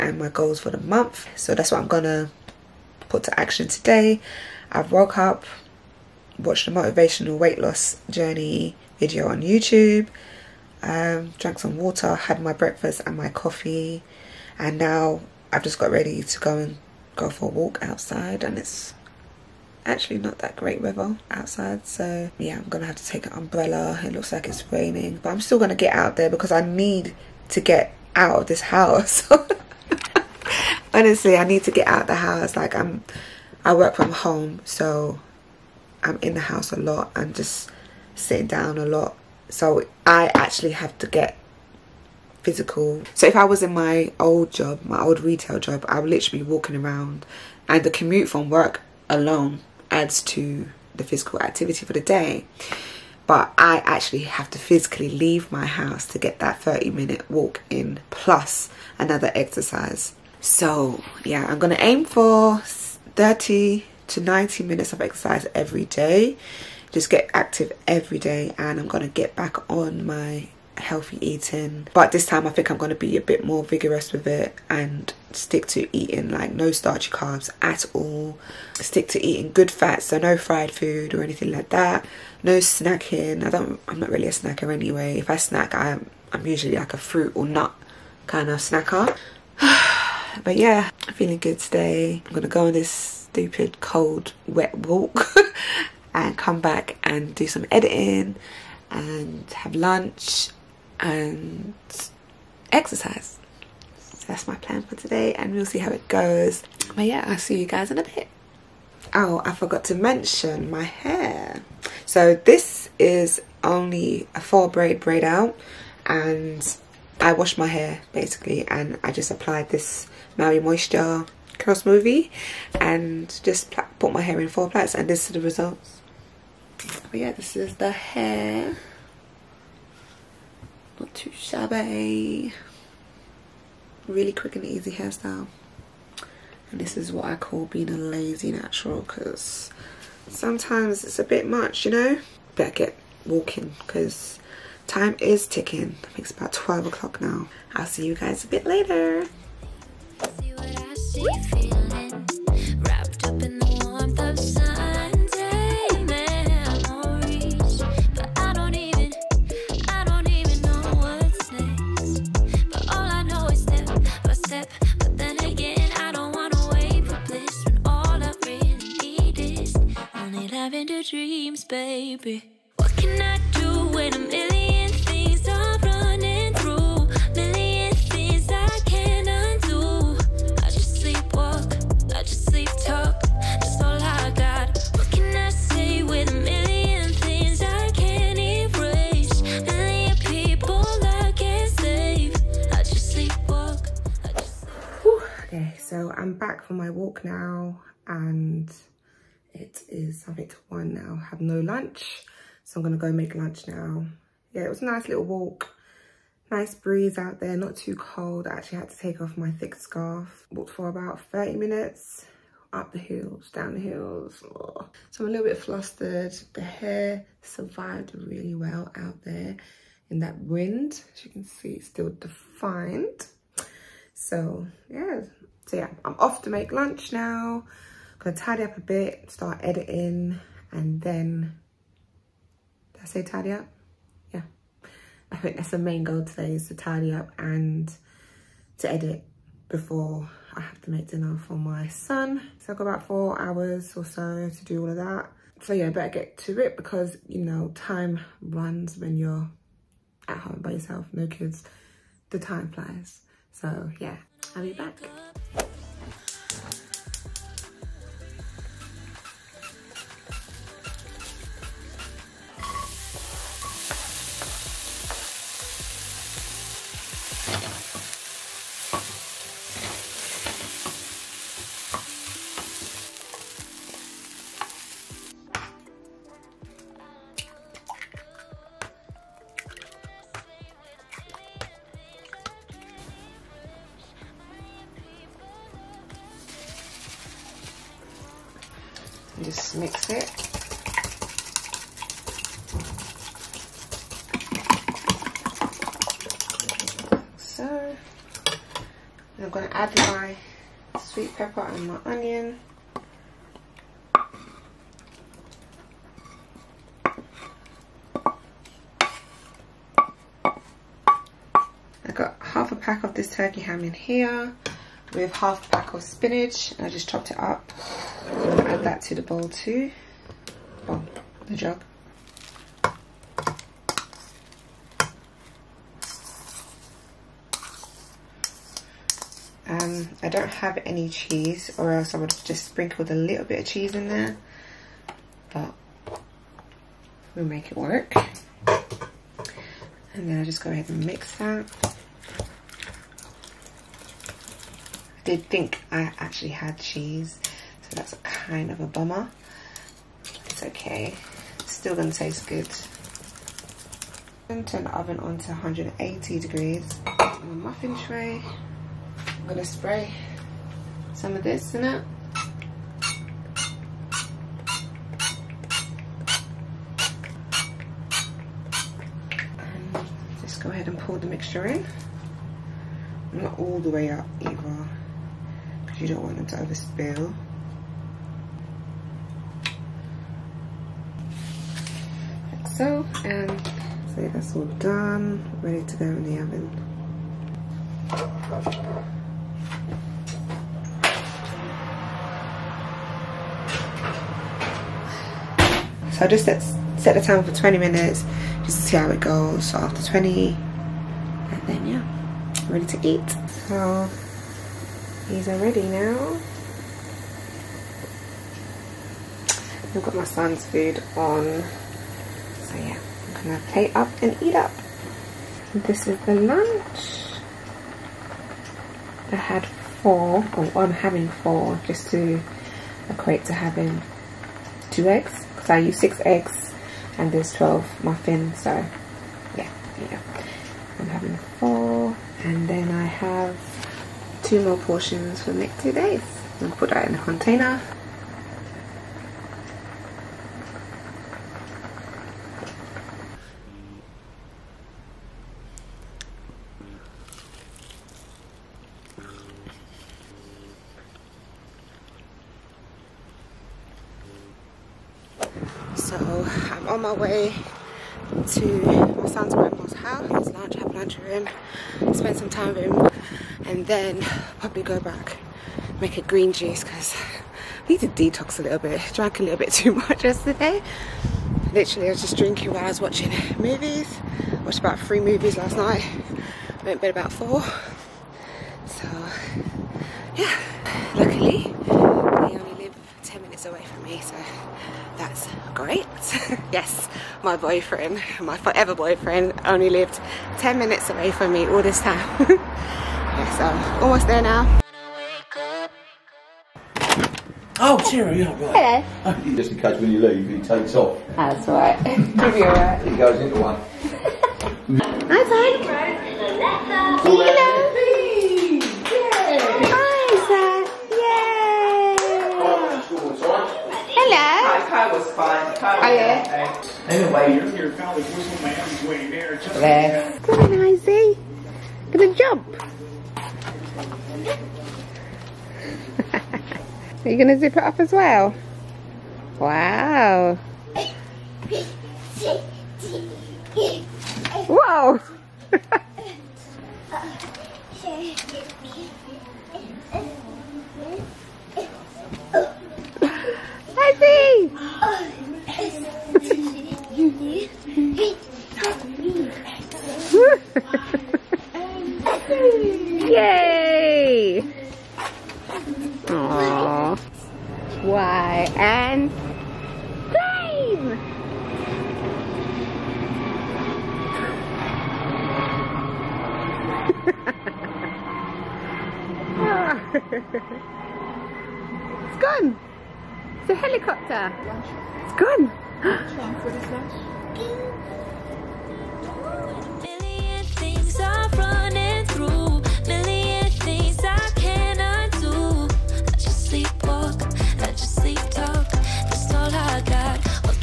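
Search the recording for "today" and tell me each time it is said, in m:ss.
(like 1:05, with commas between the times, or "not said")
0:03, 1:31, 1:44, 3:56.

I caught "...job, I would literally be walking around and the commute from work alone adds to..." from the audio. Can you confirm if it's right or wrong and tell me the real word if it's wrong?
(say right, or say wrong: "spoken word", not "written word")
right.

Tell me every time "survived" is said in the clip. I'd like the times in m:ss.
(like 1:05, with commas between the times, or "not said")
3:37.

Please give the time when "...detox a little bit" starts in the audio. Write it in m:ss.
7:48.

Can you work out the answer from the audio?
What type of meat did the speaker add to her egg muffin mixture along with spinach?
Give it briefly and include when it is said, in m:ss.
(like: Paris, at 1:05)
turkey ham, at 5:13.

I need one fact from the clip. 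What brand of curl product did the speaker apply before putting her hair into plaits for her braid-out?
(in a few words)
Maui Moisture.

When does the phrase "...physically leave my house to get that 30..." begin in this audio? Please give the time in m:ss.
0:54.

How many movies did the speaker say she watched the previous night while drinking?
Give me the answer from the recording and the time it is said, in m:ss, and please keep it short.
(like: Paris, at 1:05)
3, at 7:54.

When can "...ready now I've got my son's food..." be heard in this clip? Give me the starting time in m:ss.
6:45.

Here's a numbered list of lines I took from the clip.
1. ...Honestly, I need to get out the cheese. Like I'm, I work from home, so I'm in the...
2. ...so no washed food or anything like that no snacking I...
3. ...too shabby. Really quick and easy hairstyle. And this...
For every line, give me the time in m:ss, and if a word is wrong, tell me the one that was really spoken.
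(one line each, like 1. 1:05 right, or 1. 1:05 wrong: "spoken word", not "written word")
1. 0:30 wrong: "house", not "cheese"
2. 1:20 wrong: "fried", not "washed"
3. 2:11 right.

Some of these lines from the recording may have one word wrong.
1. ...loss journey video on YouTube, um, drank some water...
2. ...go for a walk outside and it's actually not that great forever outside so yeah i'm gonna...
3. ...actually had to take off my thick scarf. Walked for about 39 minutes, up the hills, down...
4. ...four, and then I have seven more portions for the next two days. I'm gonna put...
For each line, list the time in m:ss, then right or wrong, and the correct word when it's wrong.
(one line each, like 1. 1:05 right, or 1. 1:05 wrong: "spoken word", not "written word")
1. 0:07 right
2. 0:17 wrong: "weather", not "forever"
3. 3:28 wrong: "30", not "39"
4. 7:11 wrong: "two", not "seven".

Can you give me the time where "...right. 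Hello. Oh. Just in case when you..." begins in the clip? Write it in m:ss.
8:18.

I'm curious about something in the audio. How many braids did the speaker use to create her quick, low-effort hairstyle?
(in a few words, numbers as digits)
4.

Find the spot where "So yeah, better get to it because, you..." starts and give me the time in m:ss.
4:05.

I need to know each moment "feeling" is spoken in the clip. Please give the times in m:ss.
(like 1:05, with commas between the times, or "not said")
1:31.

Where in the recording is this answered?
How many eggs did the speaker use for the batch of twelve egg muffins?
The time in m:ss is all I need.
7:05.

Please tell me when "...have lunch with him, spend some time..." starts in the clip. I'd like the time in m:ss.
7:40.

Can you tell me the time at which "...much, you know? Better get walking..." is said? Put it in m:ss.
2:21.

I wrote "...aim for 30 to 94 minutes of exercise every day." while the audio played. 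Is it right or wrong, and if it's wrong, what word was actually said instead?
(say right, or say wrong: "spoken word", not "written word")
wrong: "90", not "94".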